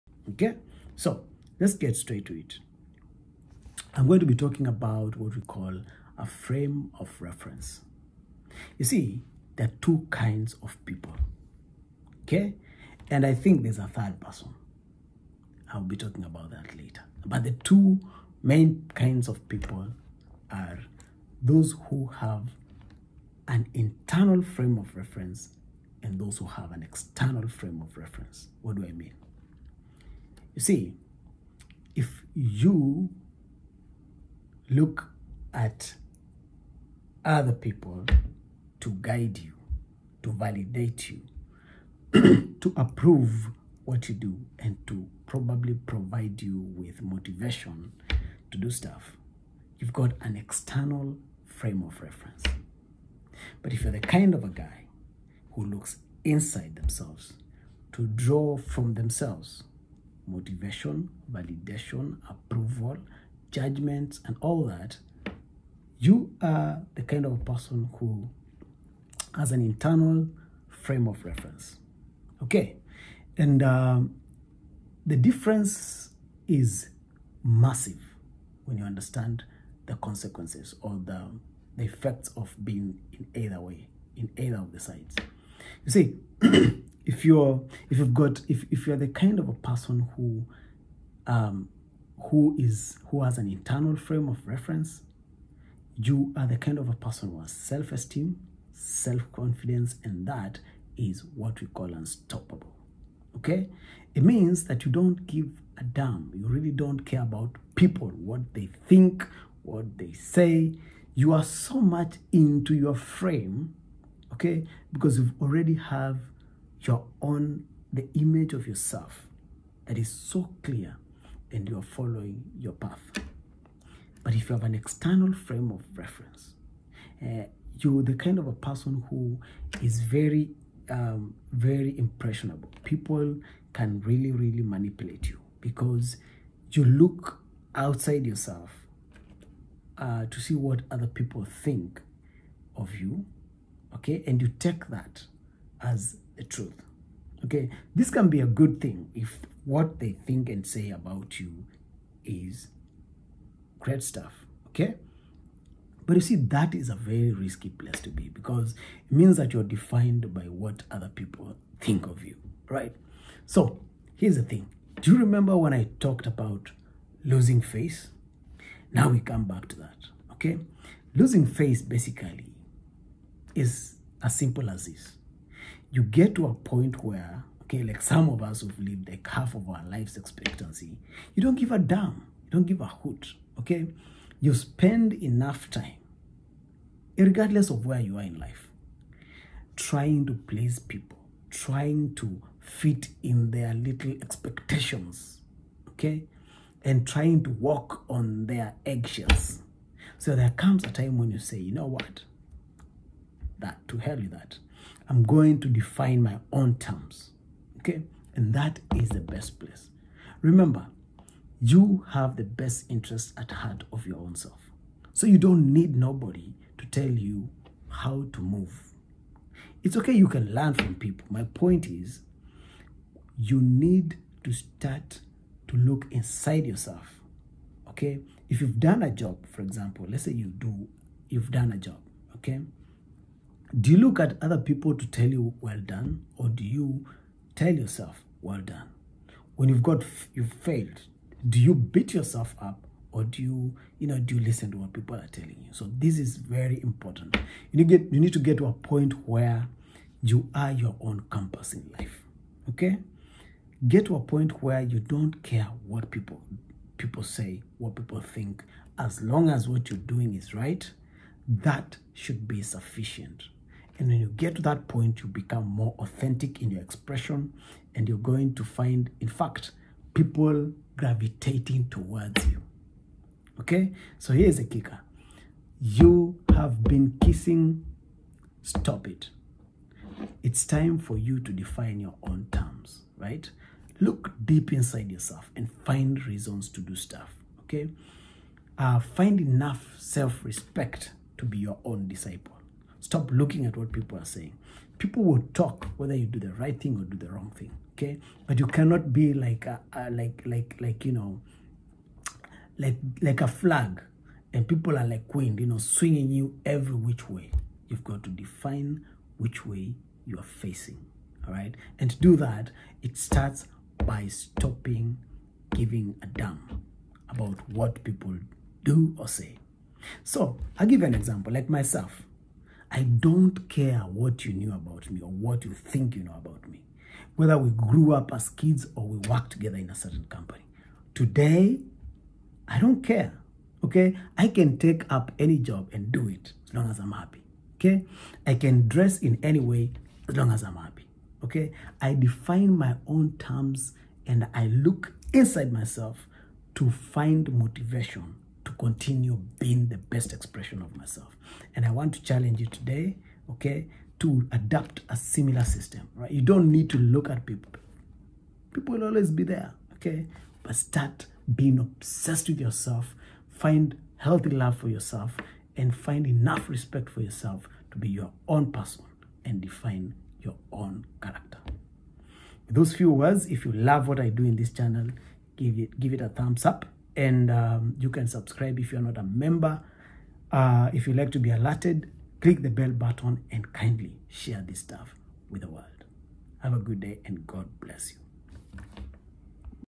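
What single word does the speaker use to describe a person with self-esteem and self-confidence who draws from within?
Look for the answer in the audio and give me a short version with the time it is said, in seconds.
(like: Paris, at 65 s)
Unstoppable, at 101 s.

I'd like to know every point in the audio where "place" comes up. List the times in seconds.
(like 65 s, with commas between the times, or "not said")
157 s, 209 s.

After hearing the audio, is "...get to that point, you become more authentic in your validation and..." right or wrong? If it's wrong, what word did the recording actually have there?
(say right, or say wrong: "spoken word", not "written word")
wrong: "expression", not "validation".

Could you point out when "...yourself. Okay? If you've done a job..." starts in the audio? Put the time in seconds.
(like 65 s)
226 s.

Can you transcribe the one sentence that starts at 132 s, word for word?
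People can really, really manipulate you because you look outside yourself uh, to see what other people think of you, okay?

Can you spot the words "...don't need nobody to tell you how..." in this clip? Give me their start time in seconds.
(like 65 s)
215 s.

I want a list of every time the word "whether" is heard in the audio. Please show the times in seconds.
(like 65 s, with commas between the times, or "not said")
295 s, 327 s.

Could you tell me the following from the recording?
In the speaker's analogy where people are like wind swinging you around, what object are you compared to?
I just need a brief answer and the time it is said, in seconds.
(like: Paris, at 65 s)
A flag, at 303 s.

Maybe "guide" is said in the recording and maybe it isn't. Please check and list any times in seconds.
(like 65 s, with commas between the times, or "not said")
39 s.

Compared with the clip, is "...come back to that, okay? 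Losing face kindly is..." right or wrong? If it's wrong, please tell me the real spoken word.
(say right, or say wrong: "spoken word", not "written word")
wrong: "basically", not "kindly".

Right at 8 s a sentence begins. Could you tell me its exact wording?
You see, there are two kinds of people.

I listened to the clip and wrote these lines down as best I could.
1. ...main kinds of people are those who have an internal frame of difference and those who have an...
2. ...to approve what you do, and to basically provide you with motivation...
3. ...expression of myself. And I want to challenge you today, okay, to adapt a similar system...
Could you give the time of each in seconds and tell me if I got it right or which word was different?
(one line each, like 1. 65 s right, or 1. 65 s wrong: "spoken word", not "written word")
1. 18 s wrong: "reference", not "difference"
2. 42 s wrong: "probably", not "basically"
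3. 350 s right.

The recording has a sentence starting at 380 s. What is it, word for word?
Uh, if you like to be alerted, click the bell button and kindly share this stuff with the world.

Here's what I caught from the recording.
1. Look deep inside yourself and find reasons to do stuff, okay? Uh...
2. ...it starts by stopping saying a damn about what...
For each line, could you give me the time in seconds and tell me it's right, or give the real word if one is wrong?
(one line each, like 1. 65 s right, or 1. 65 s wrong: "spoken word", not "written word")
1. 283 s right
2. 313 s wrong: "giving", not "saying".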